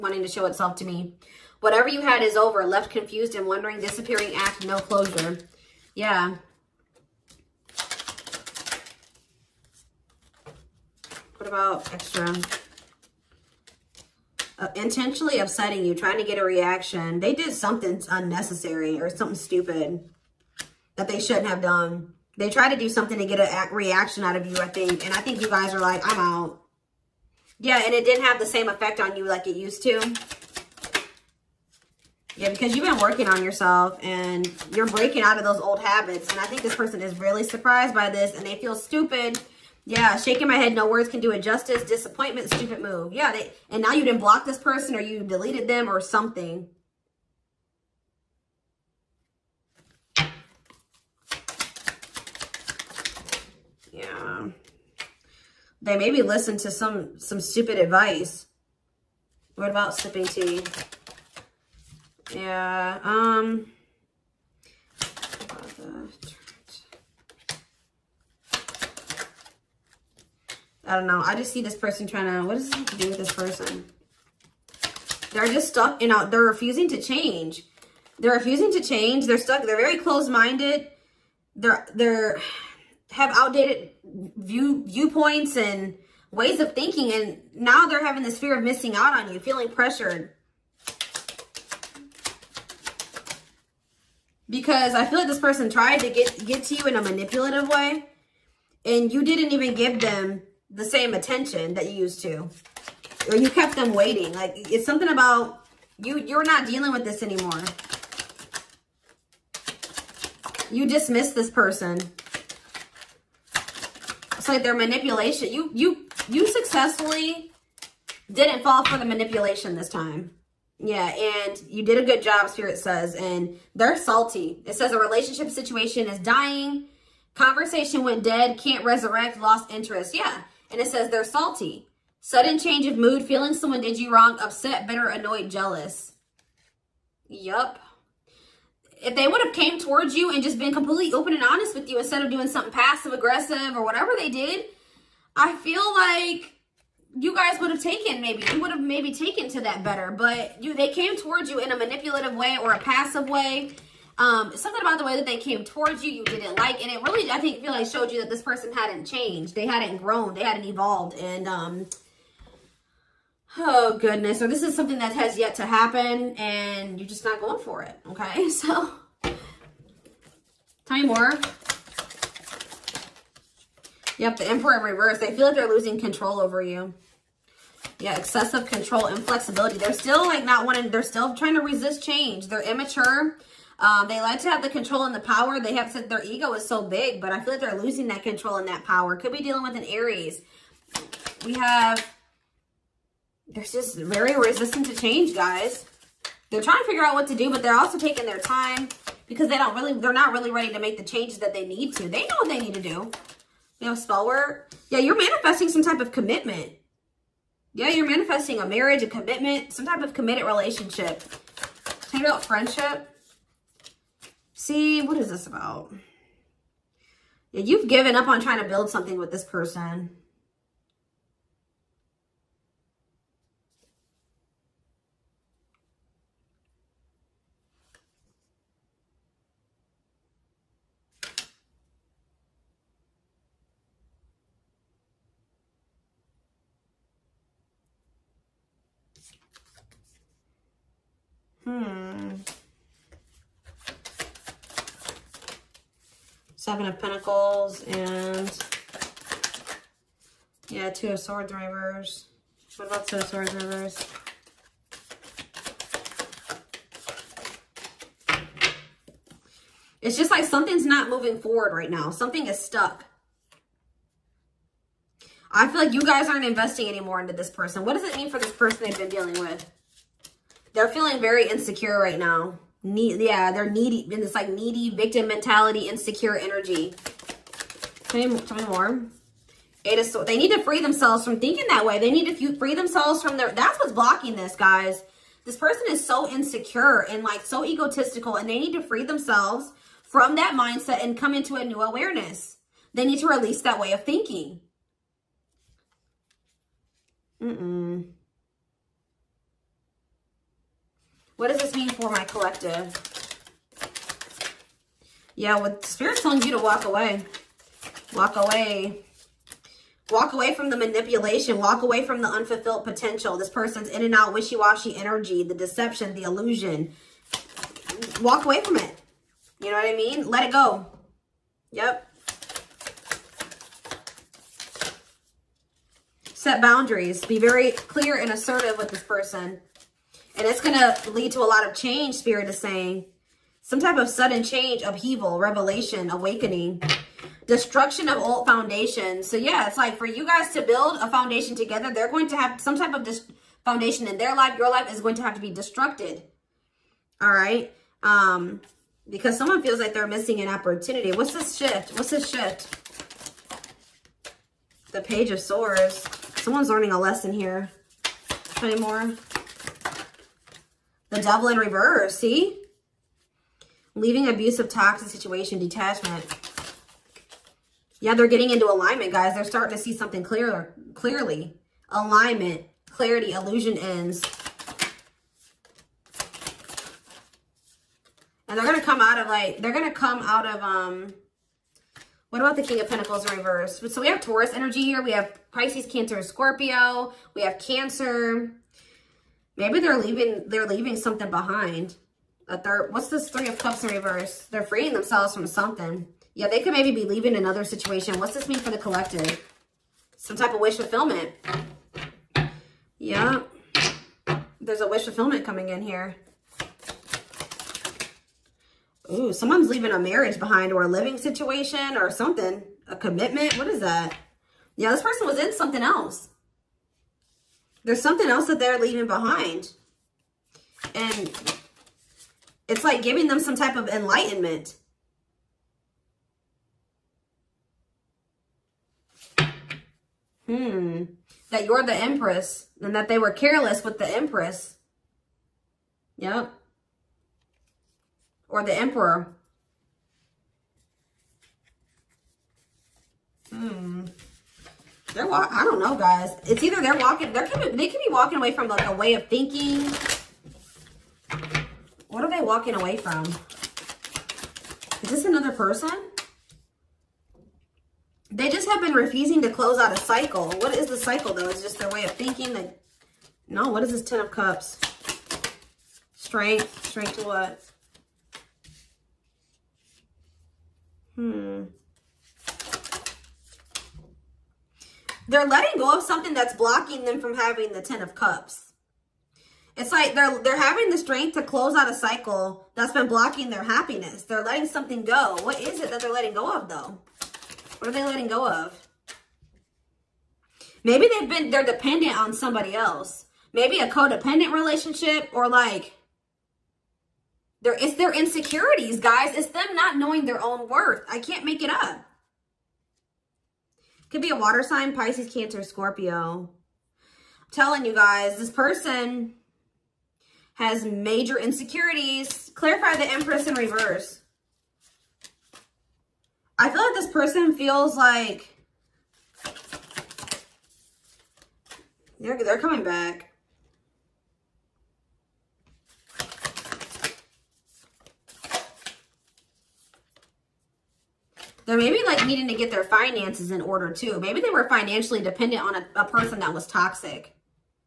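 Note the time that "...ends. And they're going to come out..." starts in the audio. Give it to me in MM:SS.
06:13.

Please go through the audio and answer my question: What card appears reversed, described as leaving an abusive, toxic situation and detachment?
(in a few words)
The Devil.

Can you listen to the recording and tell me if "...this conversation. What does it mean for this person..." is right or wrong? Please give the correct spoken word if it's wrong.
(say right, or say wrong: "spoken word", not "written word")
wrong: "person", not "conversation".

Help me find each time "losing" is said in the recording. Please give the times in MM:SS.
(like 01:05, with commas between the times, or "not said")
02:55, 03:07.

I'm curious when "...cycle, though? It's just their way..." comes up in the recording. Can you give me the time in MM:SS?
07:40.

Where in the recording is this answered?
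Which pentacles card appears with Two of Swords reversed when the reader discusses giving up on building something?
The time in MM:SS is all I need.
04:06.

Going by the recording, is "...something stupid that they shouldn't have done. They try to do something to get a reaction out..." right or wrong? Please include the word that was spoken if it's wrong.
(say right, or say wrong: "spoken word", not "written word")
right.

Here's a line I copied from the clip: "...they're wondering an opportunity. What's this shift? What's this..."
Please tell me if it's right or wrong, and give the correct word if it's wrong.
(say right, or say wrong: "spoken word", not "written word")
wrong: "missing", not "wondering".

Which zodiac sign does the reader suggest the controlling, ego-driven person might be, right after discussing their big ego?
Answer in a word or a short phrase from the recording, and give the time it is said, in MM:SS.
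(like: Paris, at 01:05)
Aries, at 03:09.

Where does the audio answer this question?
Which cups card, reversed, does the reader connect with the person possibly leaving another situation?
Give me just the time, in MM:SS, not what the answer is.
06:33.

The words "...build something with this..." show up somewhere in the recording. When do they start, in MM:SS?
03:38.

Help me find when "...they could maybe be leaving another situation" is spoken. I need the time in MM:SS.
06:36.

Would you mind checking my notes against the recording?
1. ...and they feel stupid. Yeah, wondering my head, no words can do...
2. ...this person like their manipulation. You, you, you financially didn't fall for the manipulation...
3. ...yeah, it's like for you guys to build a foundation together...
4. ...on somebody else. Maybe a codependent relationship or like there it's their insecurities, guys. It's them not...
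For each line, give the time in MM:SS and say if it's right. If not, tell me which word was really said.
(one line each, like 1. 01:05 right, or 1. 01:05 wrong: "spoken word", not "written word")
1. 00:38 wrong: "shaking", not "wondering"
2. 01:51 wrong: "successfully", not "financially"
3. 05:39 right
4. 08:12 right.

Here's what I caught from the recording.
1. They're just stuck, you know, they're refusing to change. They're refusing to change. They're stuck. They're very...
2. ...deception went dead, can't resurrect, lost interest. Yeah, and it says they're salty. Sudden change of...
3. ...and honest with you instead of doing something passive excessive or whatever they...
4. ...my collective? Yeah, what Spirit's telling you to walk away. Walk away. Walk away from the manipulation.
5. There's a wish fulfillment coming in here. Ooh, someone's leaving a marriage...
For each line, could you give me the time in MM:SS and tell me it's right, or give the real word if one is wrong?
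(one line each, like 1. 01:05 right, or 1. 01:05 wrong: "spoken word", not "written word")
1. 01:15 right
2. 02:07 wrong: "conversation", not "deception"
3. 02:21 wrong: "aggressive", not "excessive"
4. 05:02 right
5. 06:44 right.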